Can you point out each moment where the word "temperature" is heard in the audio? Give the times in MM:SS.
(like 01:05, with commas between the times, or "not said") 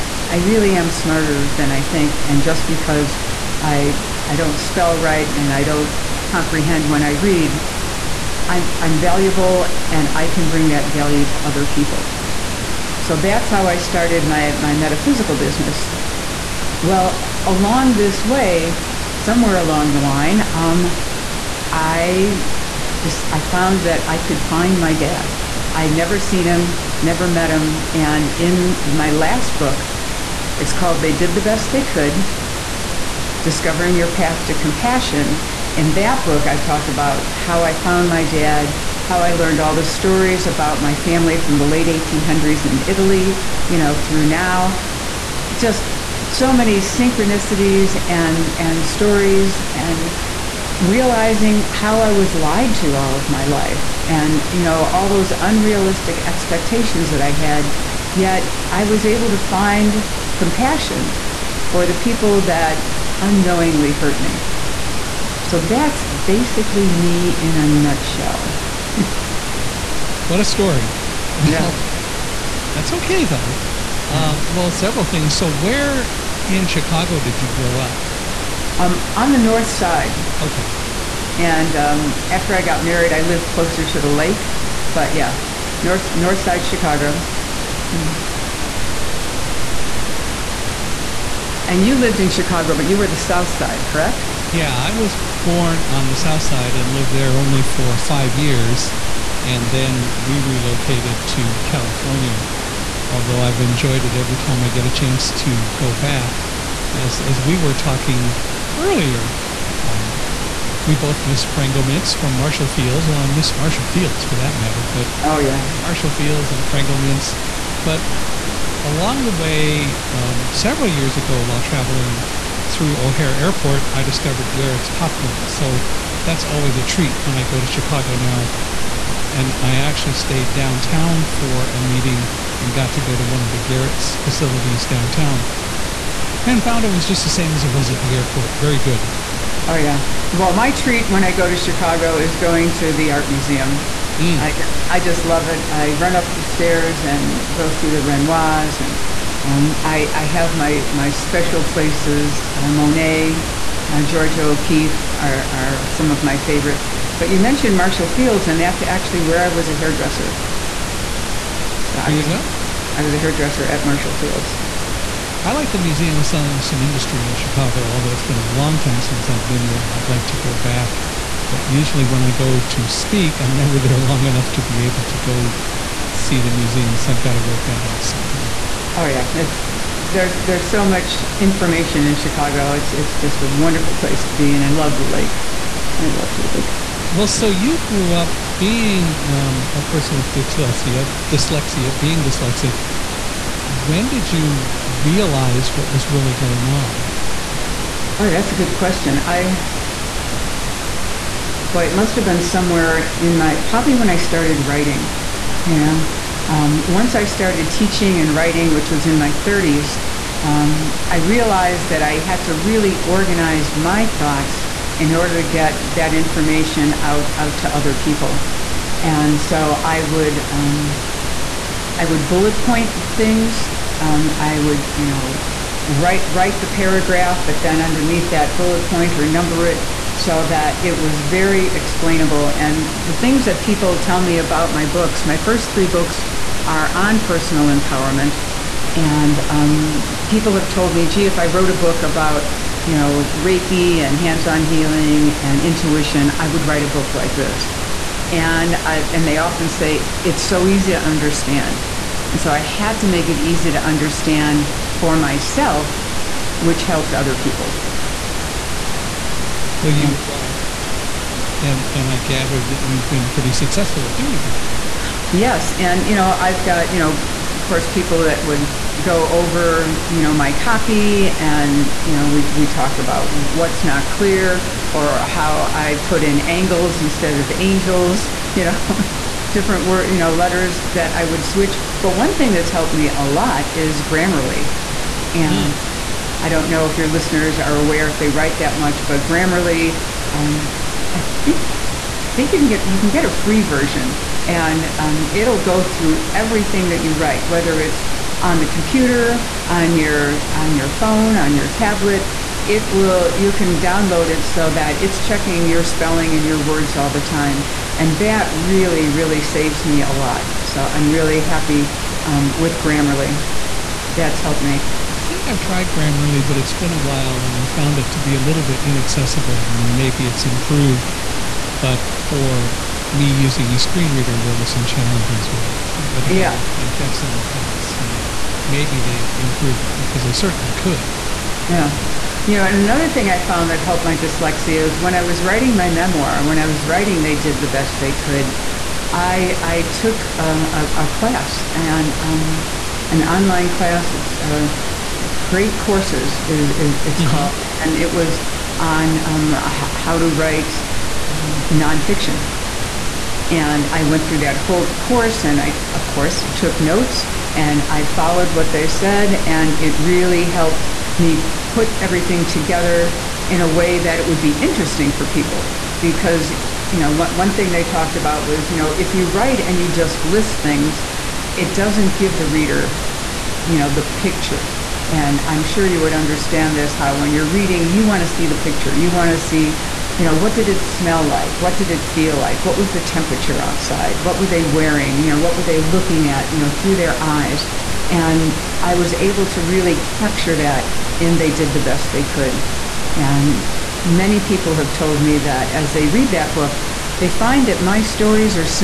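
06:23.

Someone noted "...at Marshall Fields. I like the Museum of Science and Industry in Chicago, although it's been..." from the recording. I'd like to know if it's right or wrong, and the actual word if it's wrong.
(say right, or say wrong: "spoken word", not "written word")
right.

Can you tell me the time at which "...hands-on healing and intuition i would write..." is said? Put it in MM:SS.
04:04.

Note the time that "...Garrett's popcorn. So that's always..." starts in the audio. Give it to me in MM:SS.
02:04.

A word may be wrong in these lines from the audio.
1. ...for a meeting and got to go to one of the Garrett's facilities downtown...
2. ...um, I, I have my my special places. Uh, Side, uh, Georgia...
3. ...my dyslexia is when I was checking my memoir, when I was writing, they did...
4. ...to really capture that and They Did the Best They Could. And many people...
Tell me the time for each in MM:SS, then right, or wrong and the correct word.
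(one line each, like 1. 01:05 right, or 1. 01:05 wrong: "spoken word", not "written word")
1. 02:11 right
2. 02:29 wrong: "Monet", not "Side"
3. 05:34 wrong: "writing", not "checking"
4. 06:29 right.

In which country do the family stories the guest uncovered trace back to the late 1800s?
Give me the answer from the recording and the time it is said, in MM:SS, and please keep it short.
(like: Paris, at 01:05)
Italy, at 00:42.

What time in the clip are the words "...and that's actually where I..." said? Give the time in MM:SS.
02:38.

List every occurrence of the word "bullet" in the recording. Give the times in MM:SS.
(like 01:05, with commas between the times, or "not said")
03:42, 03:48.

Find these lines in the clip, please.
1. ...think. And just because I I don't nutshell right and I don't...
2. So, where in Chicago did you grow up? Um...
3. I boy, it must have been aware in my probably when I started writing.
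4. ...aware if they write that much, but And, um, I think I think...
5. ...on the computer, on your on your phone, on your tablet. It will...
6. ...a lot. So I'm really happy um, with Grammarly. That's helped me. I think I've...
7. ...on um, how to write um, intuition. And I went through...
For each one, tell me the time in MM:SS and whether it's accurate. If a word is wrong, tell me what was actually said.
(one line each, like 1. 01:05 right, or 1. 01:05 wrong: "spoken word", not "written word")
1. 00:01 wrong: "spell", not "nutshell"
2. 01:15 right
3. 03:19 wrong: "somewhere", not "aware"
4. 04:47 wrong: "Grammarly", not "And"
5. 04:58 right
6. 05:10 right
7. 05:48 wrong: "nonfiction", not "intuition".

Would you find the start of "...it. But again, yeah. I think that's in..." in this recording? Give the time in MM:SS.
05:25.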